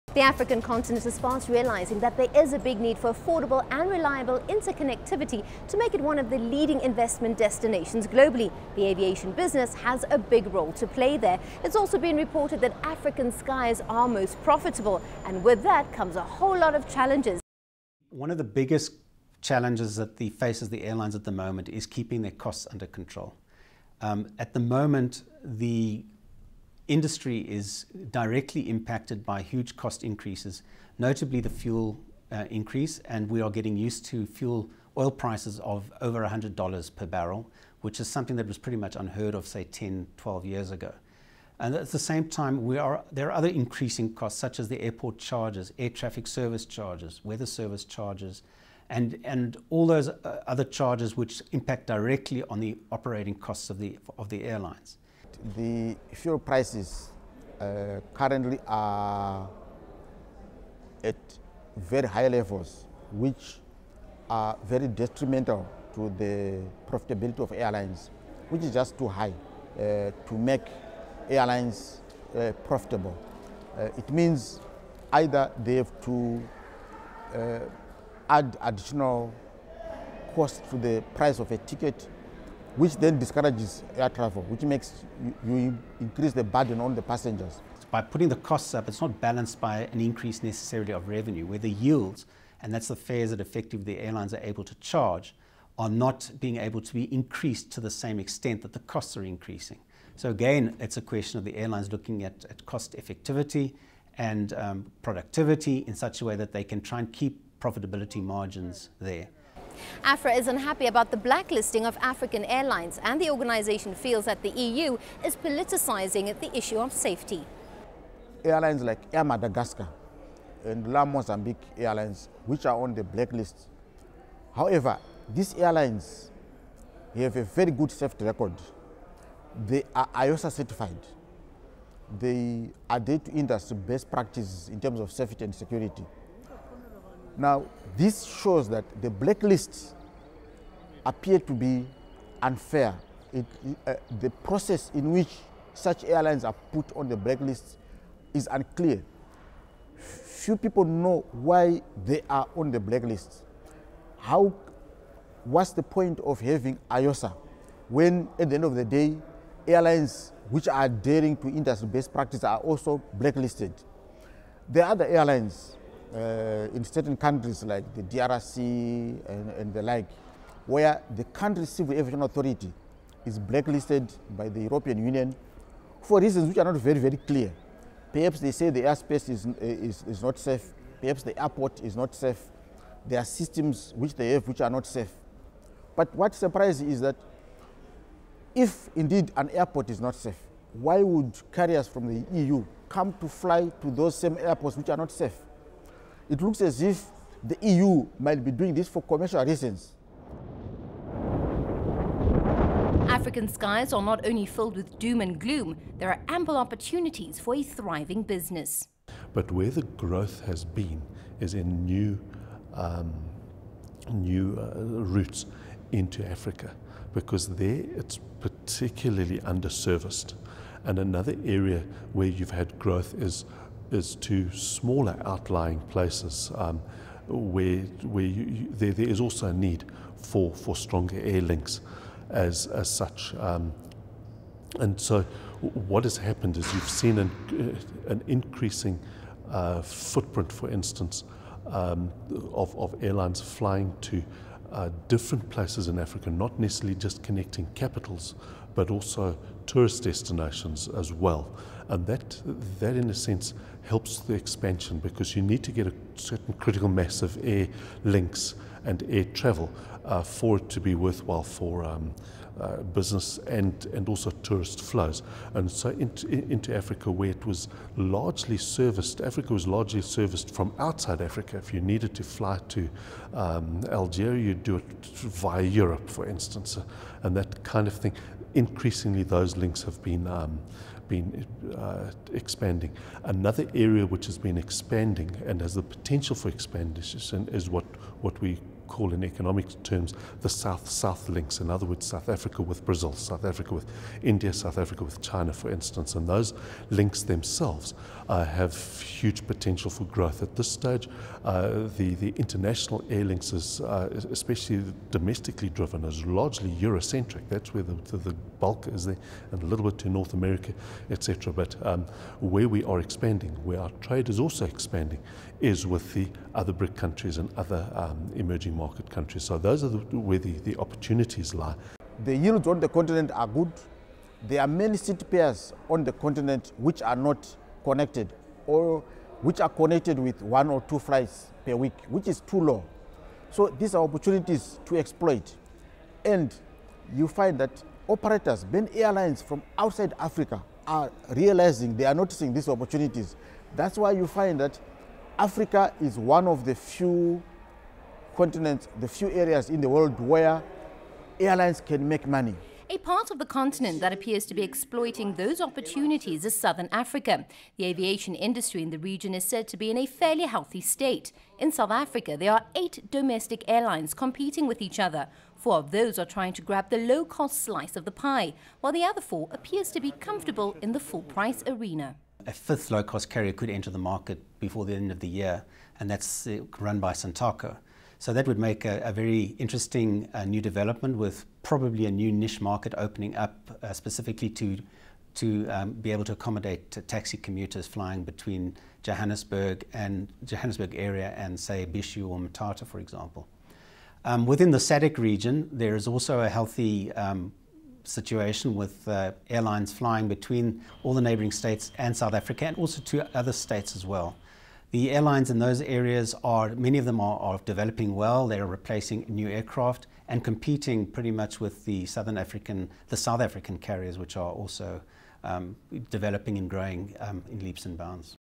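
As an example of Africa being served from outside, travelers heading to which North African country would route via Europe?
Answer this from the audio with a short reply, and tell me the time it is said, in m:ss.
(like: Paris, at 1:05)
Algeria, at 4:33.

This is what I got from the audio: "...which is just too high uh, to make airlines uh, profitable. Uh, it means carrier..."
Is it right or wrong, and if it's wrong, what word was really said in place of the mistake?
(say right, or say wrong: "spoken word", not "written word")
wrong: "either", not "carrier".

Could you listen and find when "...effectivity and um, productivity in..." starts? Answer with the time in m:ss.
1:42.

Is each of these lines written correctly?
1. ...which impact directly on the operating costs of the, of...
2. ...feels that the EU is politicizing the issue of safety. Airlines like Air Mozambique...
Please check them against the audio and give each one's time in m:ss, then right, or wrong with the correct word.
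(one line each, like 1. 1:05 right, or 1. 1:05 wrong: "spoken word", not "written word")
1. 0:51 right
2. 1:53 wrong: "Madagascar", not "Mozambique".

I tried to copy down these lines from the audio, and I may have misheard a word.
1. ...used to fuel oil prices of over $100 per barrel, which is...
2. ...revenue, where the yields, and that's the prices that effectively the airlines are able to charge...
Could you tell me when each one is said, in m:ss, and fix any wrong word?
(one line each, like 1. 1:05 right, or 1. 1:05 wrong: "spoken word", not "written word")
1. 0:33 right
2. 1:31 wrong: "fares", not "prices".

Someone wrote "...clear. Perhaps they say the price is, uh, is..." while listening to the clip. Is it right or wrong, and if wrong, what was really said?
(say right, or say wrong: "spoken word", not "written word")
wrong: "airspace", not "price".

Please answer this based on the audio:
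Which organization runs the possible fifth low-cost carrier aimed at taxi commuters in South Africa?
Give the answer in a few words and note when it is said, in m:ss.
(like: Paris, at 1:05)
Santaco, at 6:17.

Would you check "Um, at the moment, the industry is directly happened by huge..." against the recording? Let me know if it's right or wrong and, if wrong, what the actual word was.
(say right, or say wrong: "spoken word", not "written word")
wrong: "impacted", not "happened".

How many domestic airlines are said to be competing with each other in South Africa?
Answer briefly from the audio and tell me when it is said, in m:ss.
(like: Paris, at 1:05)
8, at 6:02.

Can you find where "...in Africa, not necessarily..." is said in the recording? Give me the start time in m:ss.
4:05.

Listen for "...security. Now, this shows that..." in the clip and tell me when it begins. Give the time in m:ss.
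2:15.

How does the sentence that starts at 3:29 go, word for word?
But where the growth has been is in new, um, new uh, routes into Africa, because there it's particularly underserviced.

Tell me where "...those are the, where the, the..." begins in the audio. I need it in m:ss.
5:19.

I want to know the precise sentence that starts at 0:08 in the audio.
The aviation business has a big role to play there.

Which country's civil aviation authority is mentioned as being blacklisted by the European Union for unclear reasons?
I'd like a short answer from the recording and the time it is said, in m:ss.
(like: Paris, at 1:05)
DRC, at 2:48.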